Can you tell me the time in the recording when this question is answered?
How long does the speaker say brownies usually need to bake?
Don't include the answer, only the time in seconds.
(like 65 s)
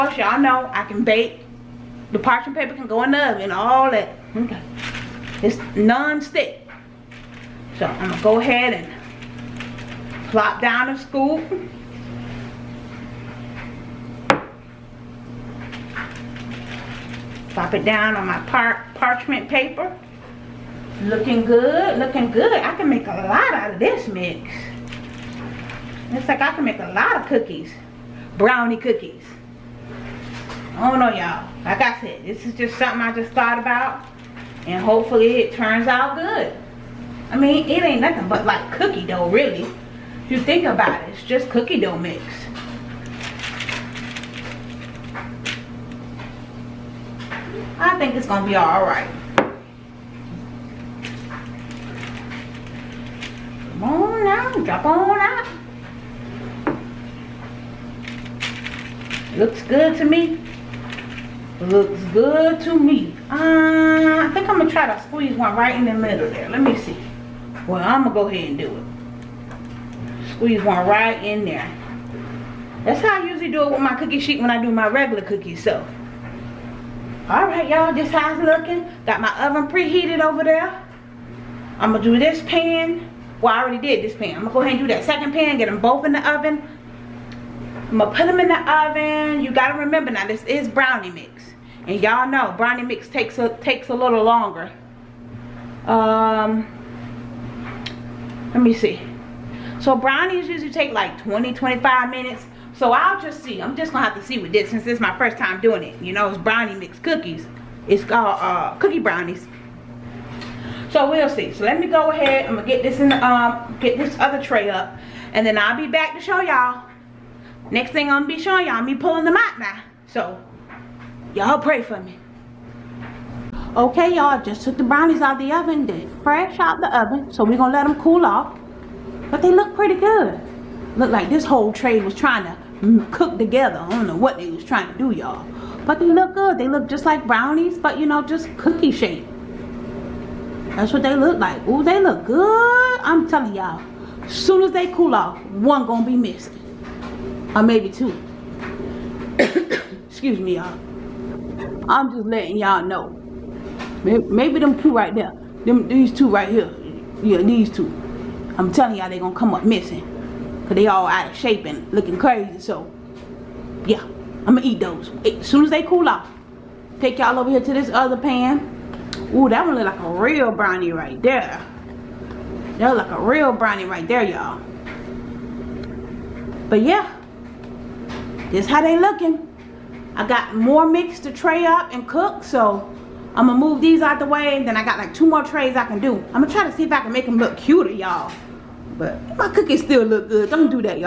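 101 s.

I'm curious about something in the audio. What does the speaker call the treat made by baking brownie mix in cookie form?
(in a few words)
cookie brownies.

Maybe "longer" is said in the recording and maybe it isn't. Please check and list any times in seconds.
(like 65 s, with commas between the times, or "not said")
94 s.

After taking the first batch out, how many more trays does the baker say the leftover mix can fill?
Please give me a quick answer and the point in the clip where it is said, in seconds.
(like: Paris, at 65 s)
2, at 185 s.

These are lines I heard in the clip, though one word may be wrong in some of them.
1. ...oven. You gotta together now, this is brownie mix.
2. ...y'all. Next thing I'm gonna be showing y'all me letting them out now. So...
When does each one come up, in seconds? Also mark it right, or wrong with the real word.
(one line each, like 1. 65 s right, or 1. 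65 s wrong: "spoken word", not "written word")
1. 88 s wrong: "remember", not "together"
2. 116 s wrong: "pulling", not "letting".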